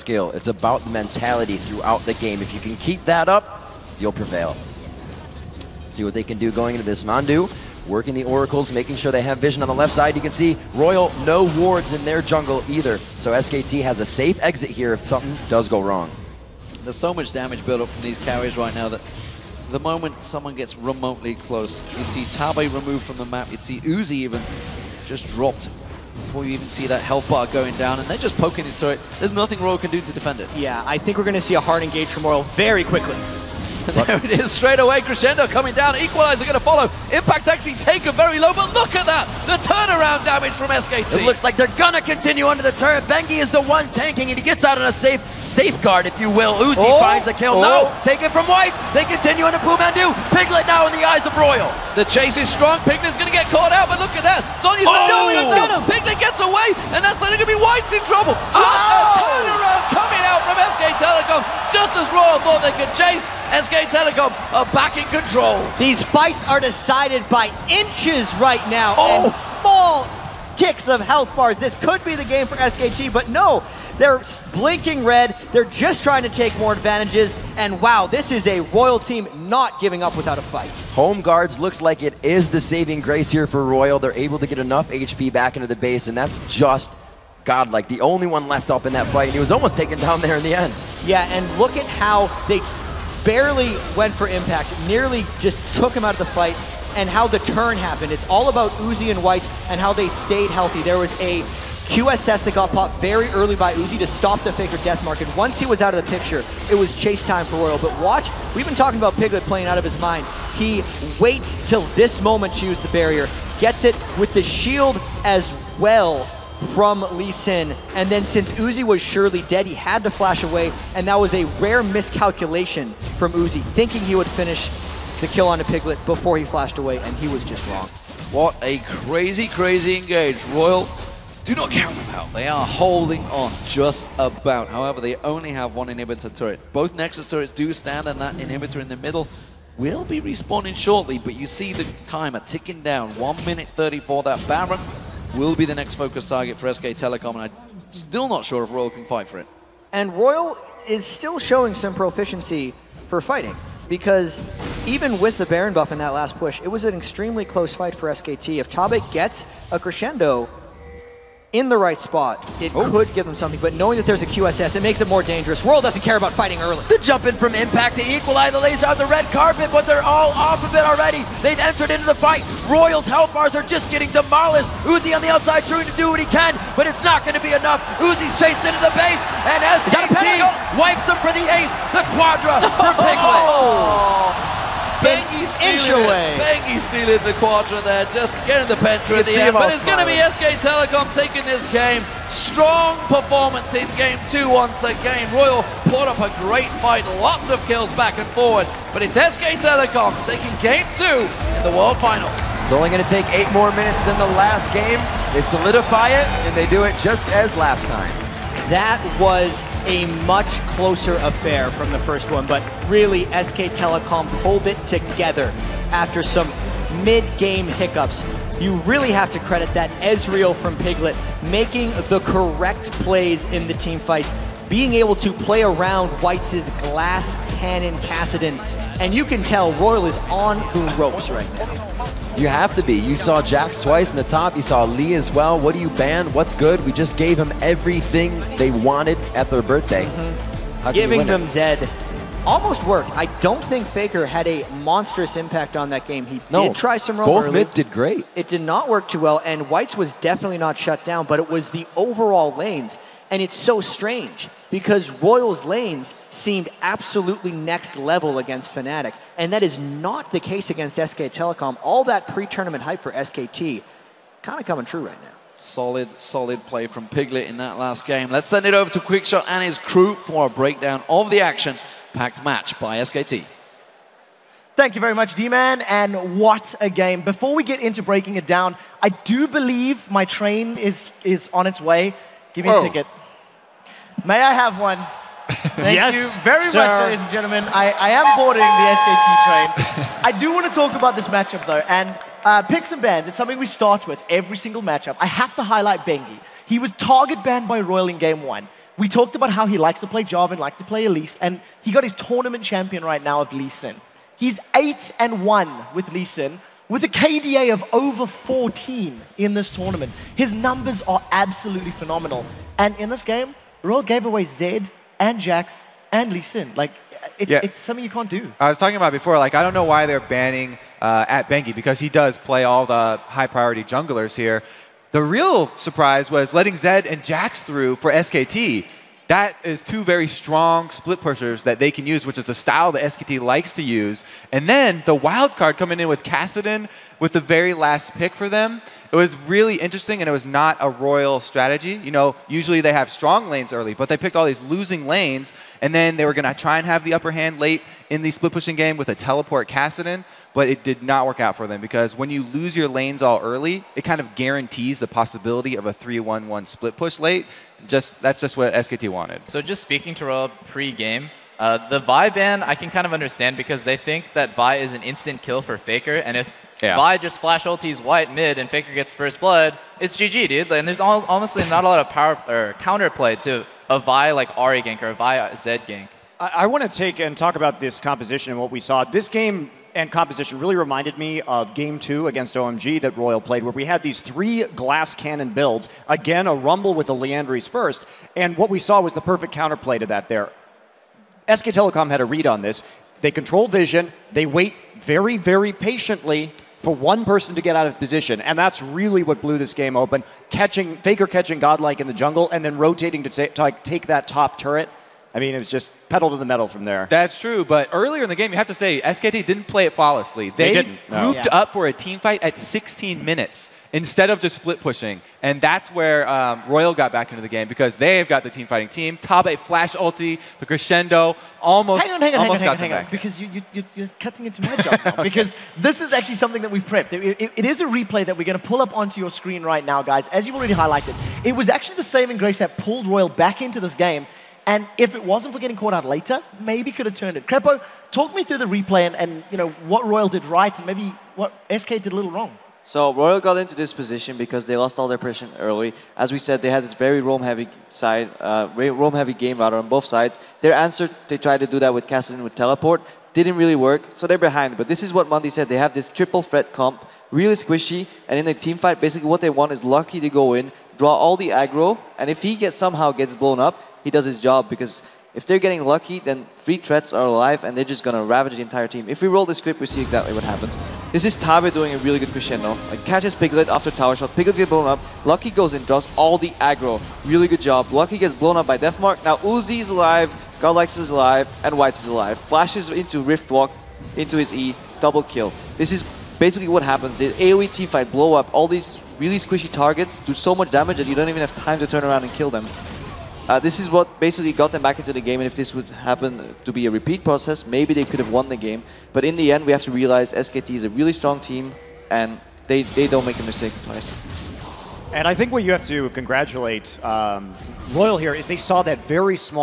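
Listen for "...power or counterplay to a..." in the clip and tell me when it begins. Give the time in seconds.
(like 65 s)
372 s.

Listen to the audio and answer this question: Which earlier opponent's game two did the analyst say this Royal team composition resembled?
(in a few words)
OMG.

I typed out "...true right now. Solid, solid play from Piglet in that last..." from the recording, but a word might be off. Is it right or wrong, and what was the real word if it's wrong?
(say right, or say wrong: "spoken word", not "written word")
right.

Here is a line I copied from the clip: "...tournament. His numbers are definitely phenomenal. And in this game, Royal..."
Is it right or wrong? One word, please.
wrong.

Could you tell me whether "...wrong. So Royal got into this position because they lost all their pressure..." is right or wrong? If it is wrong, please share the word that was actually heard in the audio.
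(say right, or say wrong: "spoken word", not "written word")
right.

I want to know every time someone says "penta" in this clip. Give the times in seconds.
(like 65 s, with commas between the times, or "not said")
188 s.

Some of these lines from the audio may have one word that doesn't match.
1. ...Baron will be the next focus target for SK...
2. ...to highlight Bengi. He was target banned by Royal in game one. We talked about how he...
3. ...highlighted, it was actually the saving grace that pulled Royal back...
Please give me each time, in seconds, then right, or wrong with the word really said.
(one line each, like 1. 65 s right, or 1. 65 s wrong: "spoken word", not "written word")
1. 144 s right
2. 295 s right
3. 430 s right.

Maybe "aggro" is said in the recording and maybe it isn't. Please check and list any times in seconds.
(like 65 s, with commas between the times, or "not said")
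461 s, 476 s.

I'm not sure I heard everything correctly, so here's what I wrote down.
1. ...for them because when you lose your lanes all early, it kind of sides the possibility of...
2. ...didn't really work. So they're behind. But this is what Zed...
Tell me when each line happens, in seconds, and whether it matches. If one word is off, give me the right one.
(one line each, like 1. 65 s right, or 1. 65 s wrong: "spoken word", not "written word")
1. 351 s wrong: "guarantees", not "sides"
2. 453 s wrong: "Monty", not "Zed".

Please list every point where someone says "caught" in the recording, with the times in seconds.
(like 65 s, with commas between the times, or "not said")
53 s, 435 s.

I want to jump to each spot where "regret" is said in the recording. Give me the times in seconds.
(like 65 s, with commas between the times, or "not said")
not said.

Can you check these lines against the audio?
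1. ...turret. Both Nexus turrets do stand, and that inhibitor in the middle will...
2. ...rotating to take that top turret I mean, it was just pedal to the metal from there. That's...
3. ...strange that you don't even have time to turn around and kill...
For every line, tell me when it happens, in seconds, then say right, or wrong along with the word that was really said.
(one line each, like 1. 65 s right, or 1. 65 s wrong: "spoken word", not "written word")
1. 136 s right
2. 402 s right
3. 490 s wrong: "damage", not "strange".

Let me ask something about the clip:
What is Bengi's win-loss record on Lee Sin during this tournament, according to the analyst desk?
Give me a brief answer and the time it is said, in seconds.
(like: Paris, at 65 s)
8 and 1, at 304 s.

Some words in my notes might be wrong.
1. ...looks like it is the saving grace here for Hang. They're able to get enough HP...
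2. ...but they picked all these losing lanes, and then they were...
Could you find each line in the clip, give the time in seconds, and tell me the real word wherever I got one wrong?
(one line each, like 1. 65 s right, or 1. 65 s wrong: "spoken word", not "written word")
1. 81 s wrong: "Royal", not "Hang"
2. 343 s right.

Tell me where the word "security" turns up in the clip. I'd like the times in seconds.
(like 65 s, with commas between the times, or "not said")
not said.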